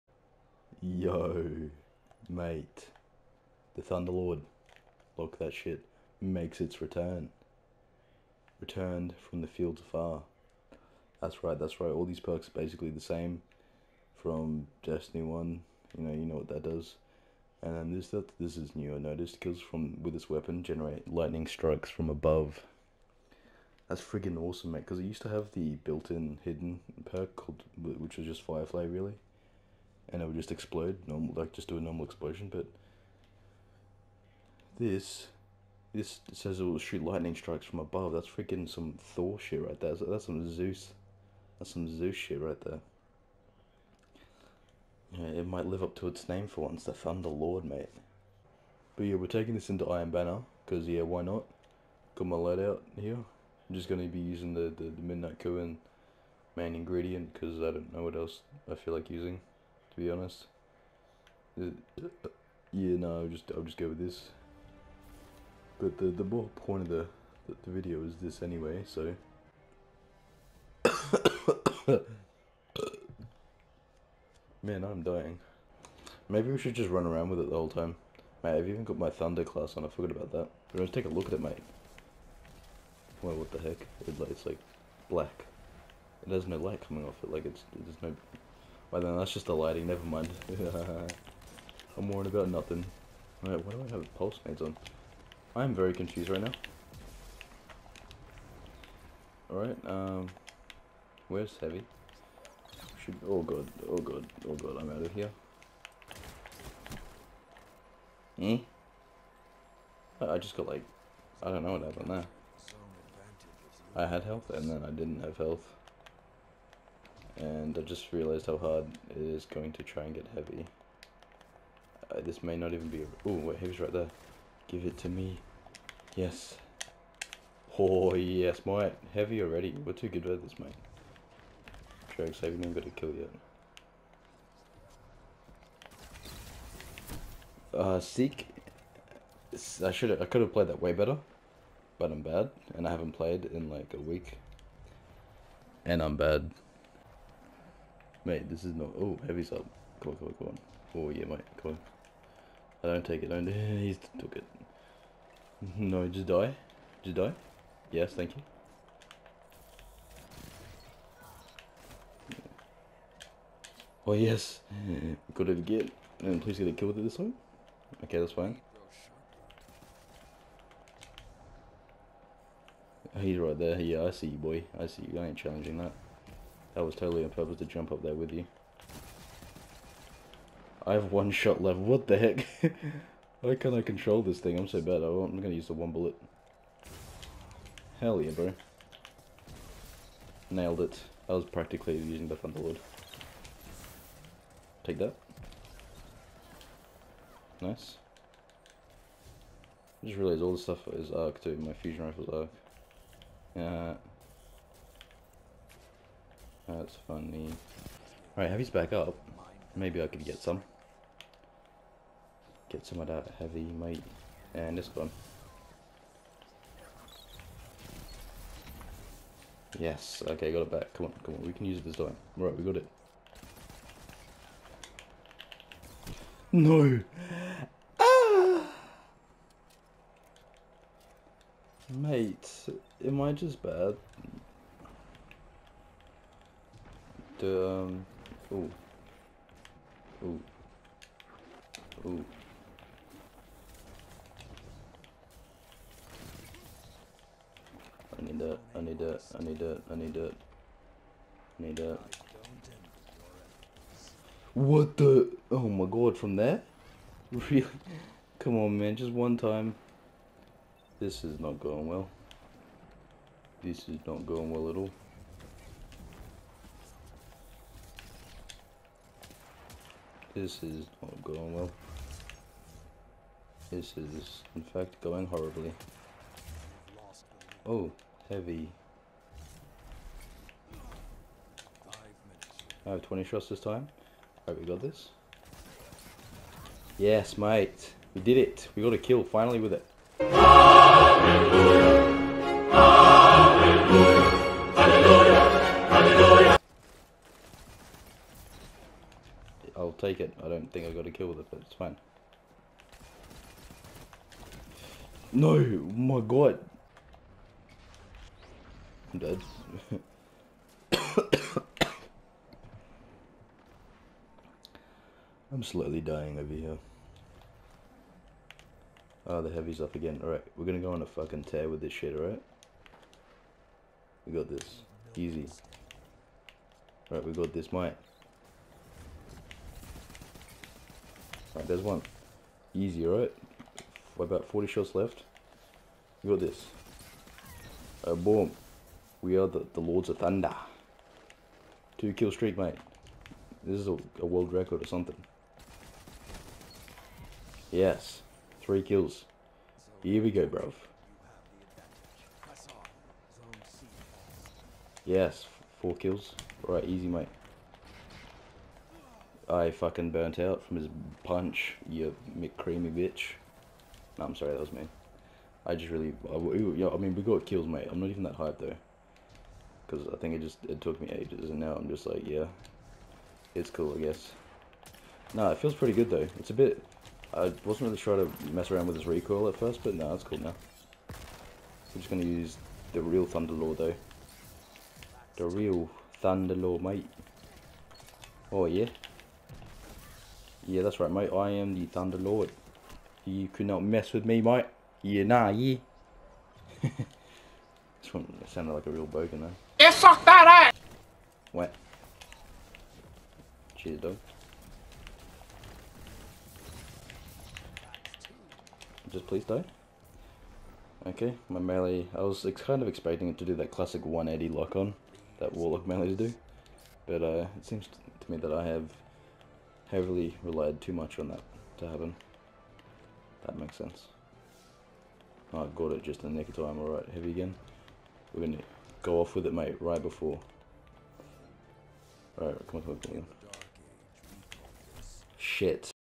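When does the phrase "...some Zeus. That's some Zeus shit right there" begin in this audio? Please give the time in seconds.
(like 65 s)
40 s.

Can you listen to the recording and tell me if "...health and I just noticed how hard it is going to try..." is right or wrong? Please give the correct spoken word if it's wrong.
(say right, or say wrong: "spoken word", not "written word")
wrong: "realized", not "noticed".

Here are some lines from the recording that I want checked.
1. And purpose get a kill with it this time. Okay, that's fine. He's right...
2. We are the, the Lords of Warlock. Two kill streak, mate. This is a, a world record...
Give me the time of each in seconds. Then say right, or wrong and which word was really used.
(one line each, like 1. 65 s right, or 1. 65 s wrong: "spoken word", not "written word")
1. 166 s wrong: "please", not "purpose"
2. 339 s wrong: "Thunder", not "Warlock".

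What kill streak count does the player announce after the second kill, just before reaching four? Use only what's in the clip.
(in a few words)
3.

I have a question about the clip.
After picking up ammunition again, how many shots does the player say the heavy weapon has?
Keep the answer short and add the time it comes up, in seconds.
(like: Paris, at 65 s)
20, at 283 s.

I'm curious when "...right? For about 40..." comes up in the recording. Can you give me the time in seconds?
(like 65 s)
333 s.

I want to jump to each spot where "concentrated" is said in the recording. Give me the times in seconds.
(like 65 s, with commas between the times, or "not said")
not said.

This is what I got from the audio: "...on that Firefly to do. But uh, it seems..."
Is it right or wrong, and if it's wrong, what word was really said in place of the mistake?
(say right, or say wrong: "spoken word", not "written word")
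wrong: "Warlock", not "Firefly".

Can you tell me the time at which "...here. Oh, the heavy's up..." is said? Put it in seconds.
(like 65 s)
316 s.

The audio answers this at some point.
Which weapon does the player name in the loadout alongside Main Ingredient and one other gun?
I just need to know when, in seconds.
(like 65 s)
55 s.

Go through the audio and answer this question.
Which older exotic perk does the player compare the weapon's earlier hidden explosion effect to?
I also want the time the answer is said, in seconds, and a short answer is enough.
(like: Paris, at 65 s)
Firefly, at 28 s.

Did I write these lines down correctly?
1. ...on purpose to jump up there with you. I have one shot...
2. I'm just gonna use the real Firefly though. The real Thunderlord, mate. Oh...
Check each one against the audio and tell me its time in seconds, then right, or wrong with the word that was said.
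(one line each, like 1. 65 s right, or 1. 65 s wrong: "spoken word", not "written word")
1. 177 s right
2. 381 s wrong: "Thunderlord", not "Firefly".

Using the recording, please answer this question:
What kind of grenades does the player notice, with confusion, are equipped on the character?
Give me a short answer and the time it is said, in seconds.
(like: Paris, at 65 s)
Pulse grenades, at 94 s.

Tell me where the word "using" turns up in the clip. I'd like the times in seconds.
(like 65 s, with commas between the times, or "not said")
54 s, 59 s, 191 s.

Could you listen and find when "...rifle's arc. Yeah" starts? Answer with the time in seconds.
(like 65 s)
202 s.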